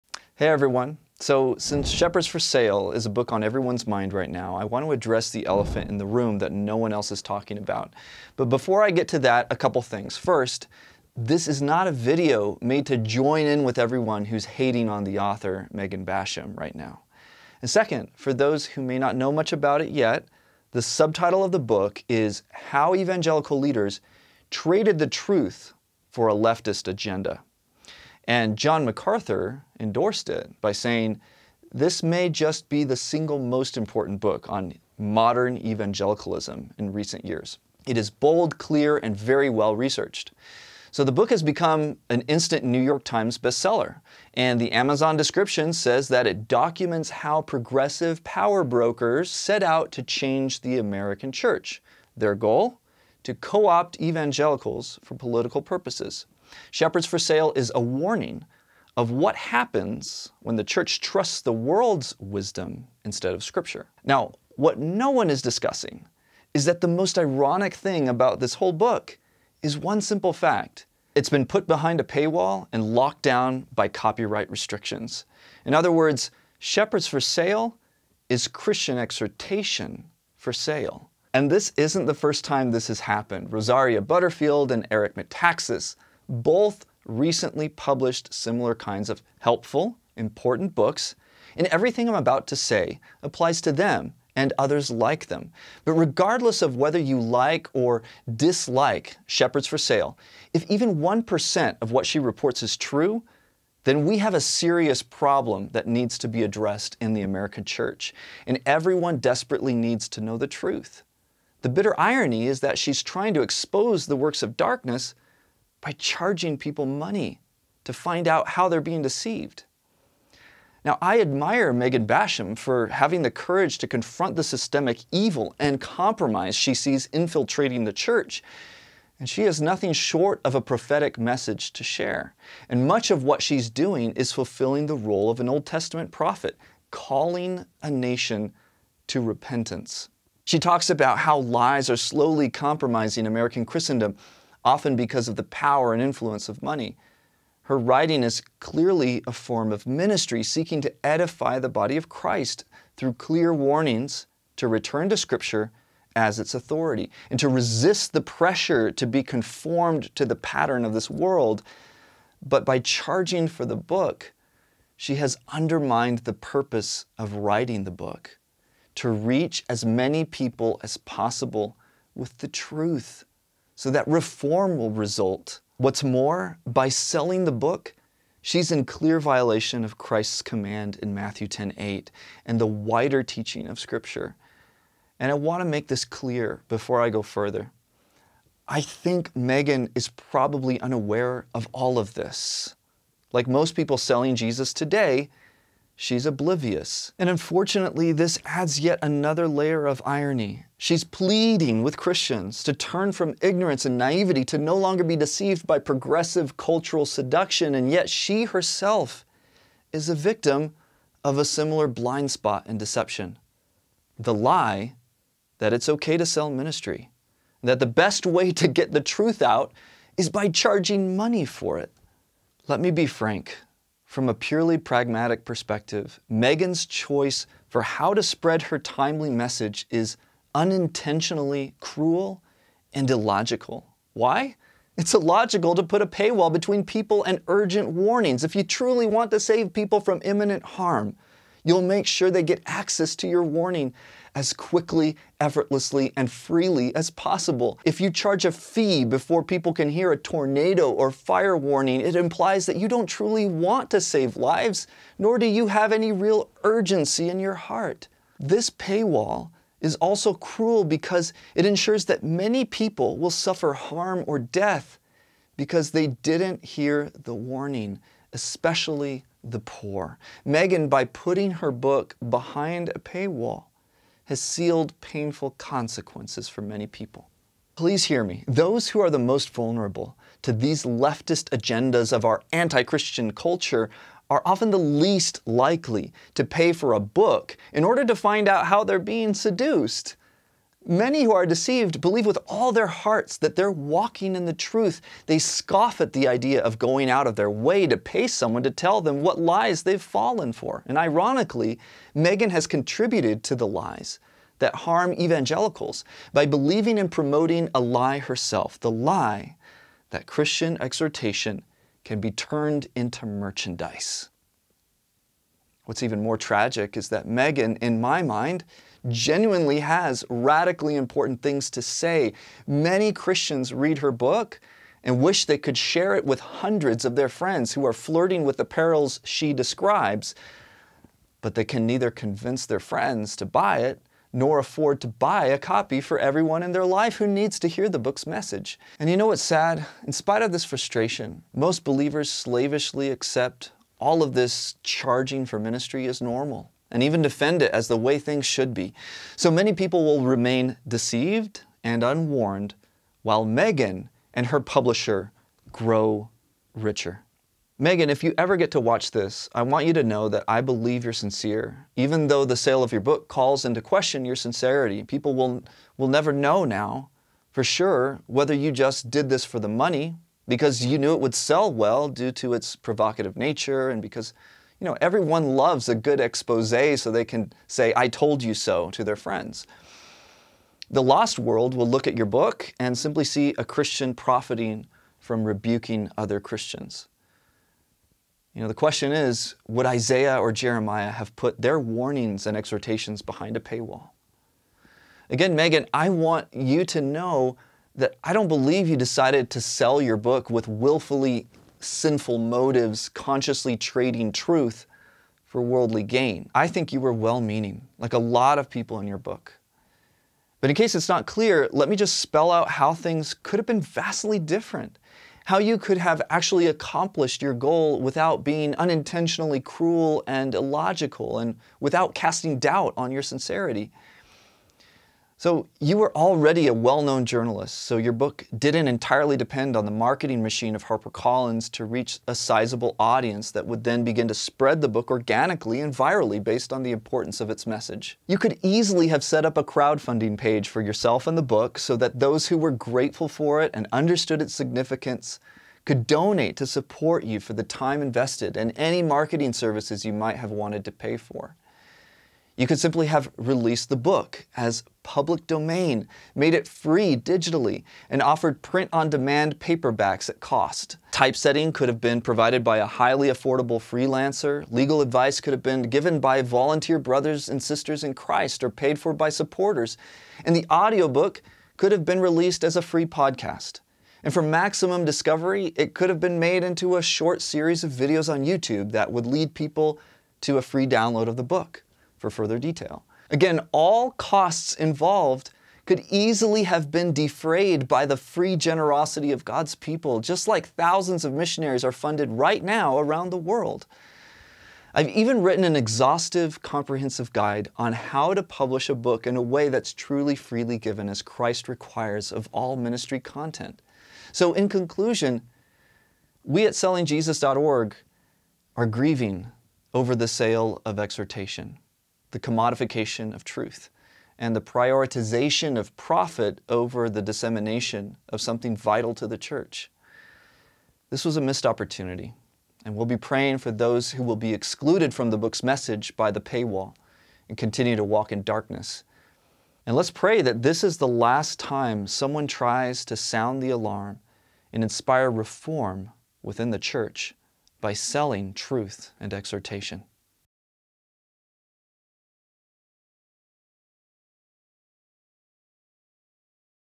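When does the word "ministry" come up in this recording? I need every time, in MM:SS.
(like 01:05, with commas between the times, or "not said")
02:29, 03:36, 05:45, 08:22.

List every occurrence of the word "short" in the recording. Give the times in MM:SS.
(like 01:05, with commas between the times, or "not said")
02:09, 07:57.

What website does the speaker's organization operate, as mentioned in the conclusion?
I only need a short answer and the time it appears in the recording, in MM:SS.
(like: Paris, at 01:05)
sellingjesus.org, at 08:26.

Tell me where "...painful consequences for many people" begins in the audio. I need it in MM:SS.
04:35.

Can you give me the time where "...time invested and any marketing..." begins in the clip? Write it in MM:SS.
07:27.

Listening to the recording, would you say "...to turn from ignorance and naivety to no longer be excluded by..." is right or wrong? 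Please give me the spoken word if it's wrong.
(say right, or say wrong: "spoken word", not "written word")
wrong: "deceived", not "excluded".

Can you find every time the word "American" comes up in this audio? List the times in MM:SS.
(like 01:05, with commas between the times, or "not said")
00:50, 01:47, 02:23.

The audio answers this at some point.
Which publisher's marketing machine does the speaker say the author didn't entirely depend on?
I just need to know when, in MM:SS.
07:10.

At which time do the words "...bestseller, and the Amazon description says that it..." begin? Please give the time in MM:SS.
00:43.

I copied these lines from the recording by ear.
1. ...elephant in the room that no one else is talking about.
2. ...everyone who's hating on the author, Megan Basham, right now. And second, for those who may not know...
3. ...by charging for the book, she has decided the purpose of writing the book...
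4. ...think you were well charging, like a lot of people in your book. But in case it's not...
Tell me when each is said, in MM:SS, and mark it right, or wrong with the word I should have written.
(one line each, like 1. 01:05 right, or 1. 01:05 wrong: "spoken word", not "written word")
1. 00:05 right
2. 00:13 right
3. 02:42 wrong: "undermined", not "decided"
4. 06:46 wrong: "meaning", not "charging".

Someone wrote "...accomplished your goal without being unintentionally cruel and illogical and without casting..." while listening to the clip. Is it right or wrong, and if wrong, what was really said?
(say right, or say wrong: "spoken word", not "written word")
right.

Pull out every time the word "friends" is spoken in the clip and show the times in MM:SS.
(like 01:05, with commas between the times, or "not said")
05:27, 05:32, 06:19.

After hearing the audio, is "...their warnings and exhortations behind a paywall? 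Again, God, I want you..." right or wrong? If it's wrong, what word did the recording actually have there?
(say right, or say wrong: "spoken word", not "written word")
wrong: "Megan", not "God".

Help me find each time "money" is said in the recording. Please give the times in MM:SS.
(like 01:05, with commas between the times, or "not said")
01:56, 02:26, 03:41, 06:09.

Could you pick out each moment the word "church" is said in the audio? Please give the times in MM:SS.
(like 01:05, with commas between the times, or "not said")
00:51, 01:00, 01:47, 02:07, 08:39, 08:56.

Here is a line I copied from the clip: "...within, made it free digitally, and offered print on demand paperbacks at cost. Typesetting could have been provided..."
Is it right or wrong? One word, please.
wrong.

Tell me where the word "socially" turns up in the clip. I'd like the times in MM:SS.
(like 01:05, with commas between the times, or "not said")
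not said.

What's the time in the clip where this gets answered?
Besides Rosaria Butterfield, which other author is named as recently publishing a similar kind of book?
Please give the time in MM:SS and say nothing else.
01:24.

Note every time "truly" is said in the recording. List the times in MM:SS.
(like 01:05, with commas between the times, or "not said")
03:58, 04:13, 08:19.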